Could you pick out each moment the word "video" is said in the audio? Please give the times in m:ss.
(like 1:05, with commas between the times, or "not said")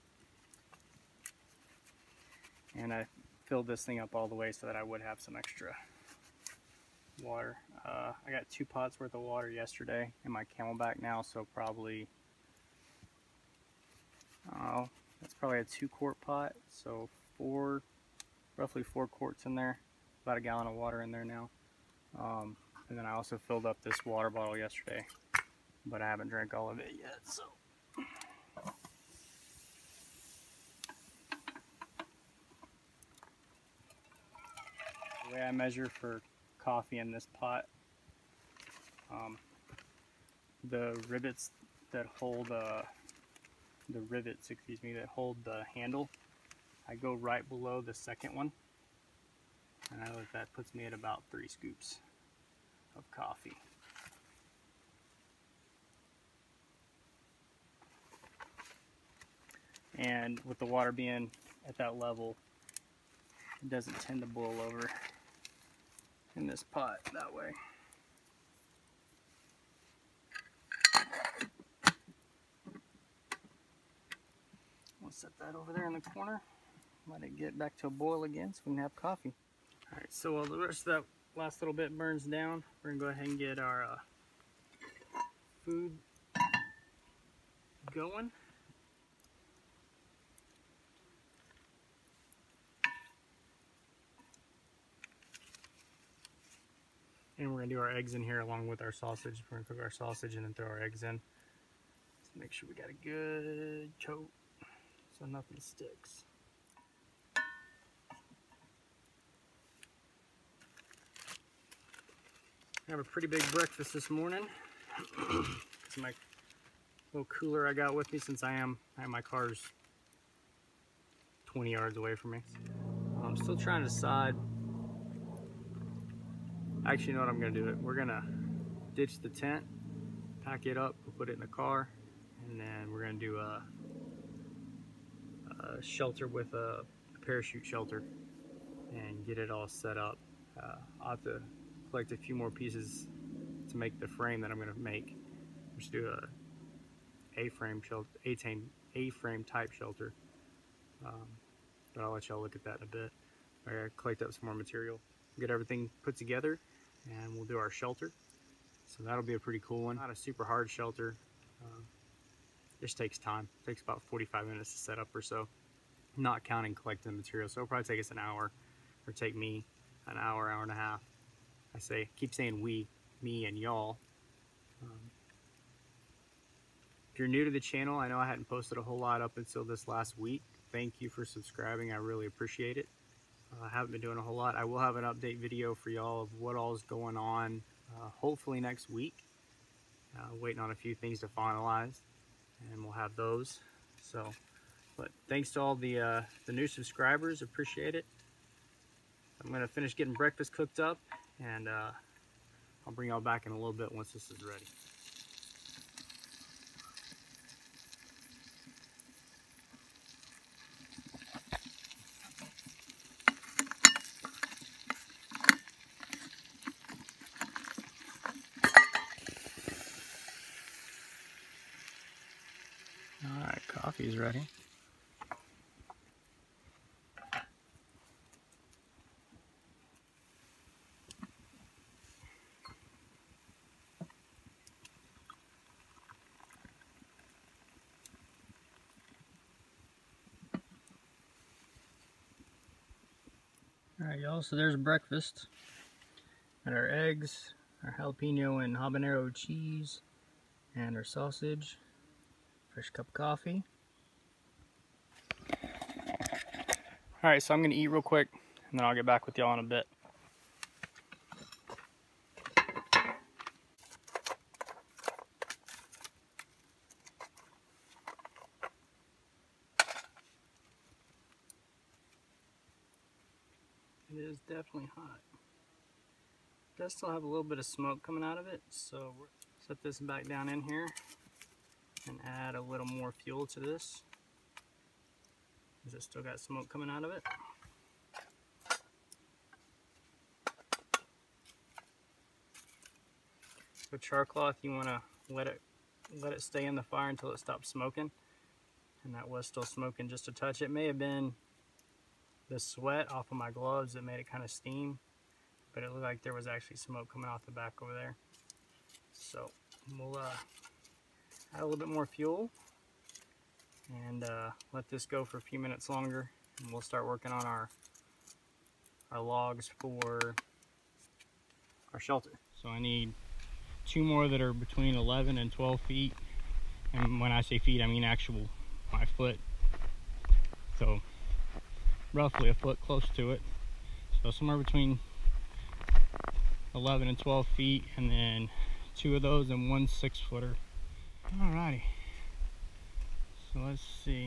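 3:05.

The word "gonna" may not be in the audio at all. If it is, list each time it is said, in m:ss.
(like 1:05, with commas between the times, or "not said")
3:19, 4:17.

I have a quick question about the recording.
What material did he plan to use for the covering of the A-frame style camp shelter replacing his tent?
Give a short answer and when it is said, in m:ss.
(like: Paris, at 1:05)
parachute, at 2:17.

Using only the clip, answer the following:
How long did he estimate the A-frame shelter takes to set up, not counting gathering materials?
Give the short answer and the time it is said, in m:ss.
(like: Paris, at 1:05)
about 45 minutes, at 2:44.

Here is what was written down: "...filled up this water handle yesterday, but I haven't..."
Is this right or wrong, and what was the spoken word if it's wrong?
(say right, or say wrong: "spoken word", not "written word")
wrong: "bottle", not "handle".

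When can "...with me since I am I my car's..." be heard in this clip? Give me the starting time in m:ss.
1:57.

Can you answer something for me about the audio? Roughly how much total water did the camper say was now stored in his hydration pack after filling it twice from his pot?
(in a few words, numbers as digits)
about a gallon.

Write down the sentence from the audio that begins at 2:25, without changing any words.
Just do a A-frame shelter, A-frame type shelter.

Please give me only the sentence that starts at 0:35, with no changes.
way I measure for coffee in this pot.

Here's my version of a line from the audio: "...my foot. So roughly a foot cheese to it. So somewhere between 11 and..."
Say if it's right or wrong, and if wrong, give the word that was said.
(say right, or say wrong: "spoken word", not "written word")
wrong: "close", not "cheese".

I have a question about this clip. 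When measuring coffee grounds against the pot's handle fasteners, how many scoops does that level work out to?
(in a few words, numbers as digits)
3 scoops.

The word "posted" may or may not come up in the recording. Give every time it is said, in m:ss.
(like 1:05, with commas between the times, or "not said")
2:58.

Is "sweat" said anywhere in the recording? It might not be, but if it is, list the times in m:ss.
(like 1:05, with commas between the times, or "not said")
5:02.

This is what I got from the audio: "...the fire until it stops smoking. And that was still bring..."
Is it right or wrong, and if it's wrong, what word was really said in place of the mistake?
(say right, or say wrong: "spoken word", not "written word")
wrong: "smoking", not "bring".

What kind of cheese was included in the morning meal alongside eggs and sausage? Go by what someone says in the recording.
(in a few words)
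jalapeno and habanero.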